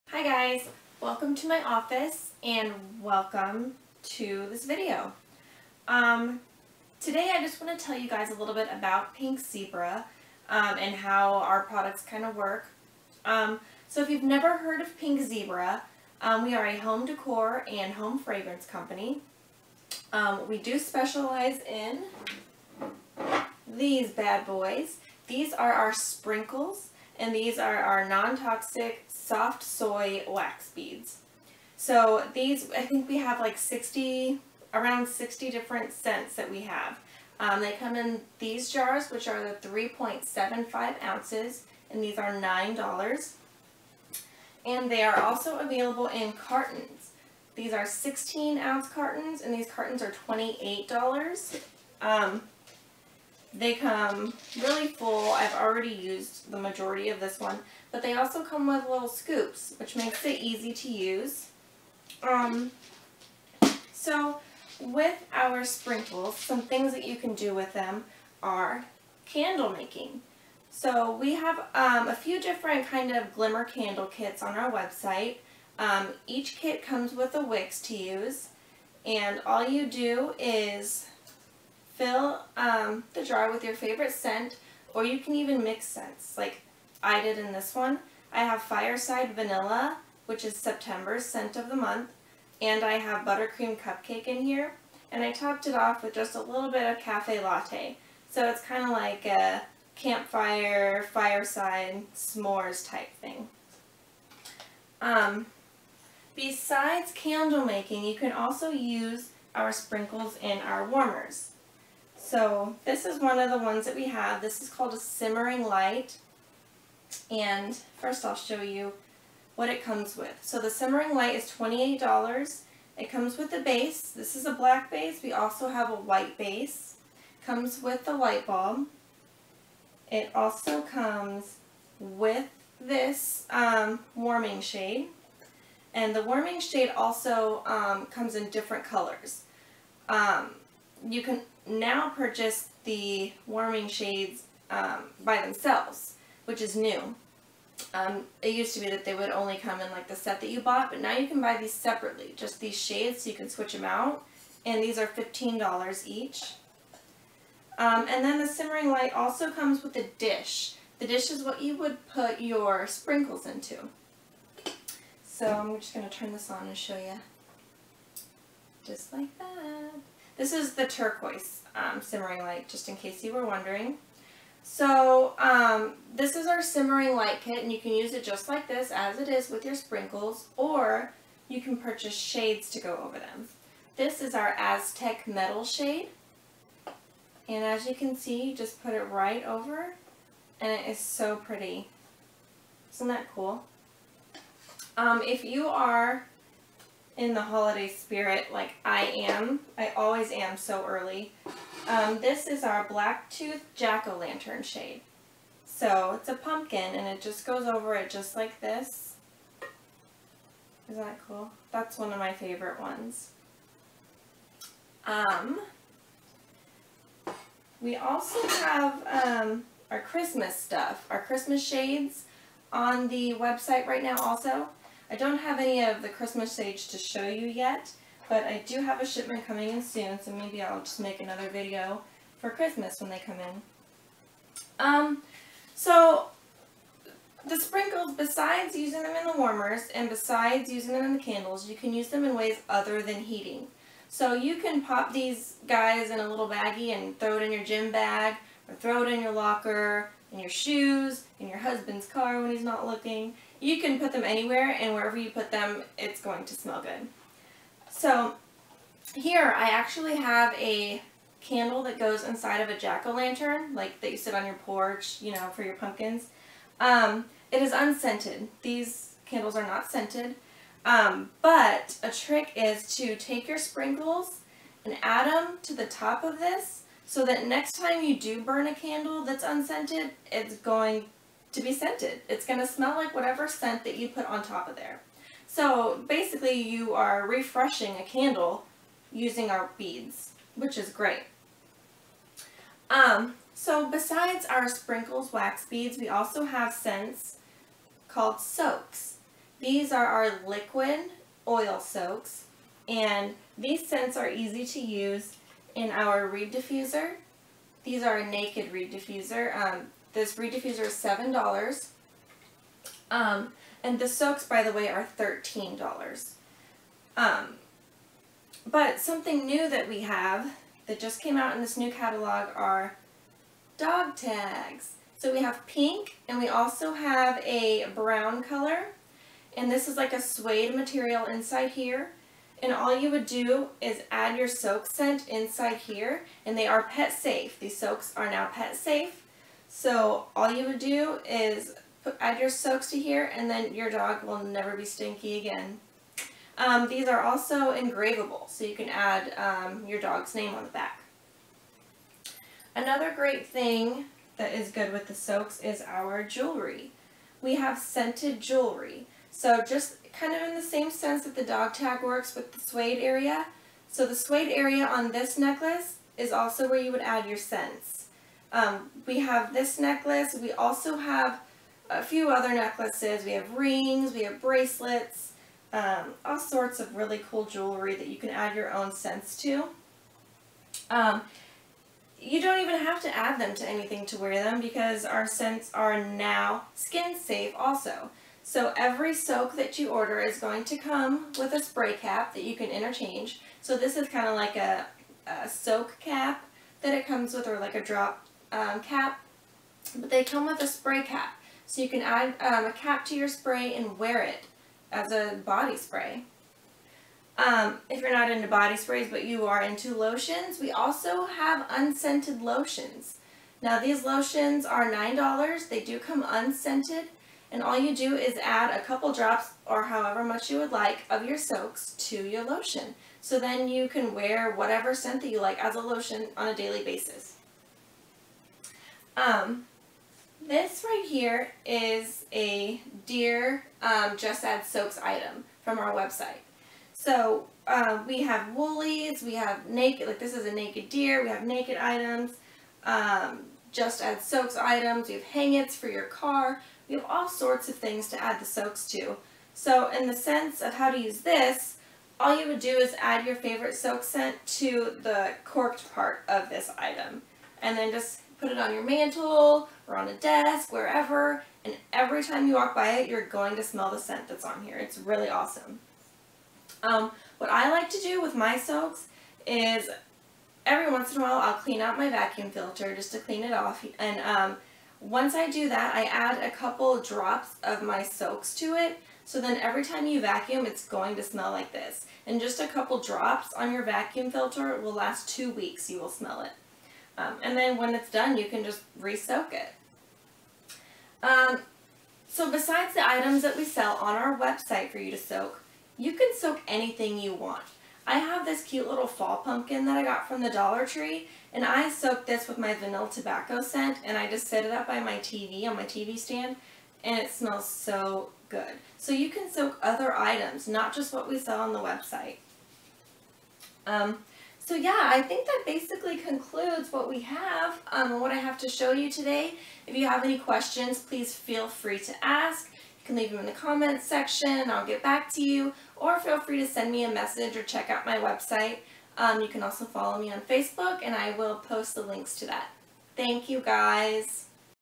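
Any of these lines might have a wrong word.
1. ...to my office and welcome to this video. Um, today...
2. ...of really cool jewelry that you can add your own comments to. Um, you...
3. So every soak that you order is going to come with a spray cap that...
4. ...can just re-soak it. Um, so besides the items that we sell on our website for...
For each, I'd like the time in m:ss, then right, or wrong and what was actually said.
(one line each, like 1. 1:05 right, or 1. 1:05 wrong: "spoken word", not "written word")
1. 0:01 right
2. 6:16 wrong: "scents", not "comments"
3. 6:28 right
4. 8:08 right.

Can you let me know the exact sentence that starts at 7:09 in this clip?
Um, this right here is a Deer um, Just Add soaks item from our website.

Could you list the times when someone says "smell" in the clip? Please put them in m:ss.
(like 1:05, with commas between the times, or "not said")
4:16, 4:42, 7:43, 8:01, 8:06, 8:27.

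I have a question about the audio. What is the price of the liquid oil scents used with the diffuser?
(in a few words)
$13.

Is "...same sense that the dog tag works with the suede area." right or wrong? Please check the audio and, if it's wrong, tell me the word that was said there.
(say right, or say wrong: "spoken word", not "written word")
right.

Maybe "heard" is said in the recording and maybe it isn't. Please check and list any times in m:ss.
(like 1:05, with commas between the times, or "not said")
0:14.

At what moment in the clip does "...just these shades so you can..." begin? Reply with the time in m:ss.
2:32.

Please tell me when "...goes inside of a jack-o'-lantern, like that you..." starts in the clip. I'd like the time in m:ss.
4:21.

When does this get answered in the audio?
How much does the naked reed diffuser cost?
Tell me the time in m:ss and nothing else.
5:10.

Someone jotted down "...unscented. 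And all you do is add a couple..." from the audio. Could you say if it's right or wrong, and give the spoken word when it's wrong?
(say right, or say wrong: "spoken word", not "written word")
right.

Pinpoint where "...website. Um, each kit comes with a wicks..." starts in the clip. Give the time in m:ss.
1:14.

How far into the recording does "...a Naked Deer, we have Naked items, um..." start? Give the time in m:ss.
7:20.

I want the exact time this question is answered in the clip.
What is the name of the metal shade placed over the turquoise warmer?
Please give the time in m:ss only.
3:04.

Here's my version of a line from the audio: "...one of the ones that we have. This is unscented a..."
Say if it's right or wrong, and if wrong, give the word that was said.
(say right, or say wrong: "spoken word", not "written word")
wrong: "called", not "unscented".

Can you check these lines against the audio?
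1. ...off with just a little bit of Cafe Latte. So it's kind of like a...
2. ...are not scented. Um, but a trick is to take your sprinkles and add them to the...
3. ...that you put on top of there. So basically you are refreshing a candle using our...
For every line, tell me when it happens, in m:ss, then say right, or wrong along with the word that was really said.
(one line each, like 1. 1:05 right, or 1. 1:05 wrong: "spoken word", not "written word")
1. 1:35 right
2. 4:29 right
3. 4:43 right.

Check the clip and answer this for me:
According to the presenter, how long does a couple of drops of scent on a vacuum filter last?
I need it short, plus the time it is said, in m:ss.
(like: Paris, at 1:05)
2 weeks, at 8:05.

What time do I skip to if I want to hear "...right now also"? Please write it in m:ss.
3:43.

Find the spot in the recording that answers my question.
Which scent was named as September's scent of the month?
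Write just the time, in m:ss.
1:28.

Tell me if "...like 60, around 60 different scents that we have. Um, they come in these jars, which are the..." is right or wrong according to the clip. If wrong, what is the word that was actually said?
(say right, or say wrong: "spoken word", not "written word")
right.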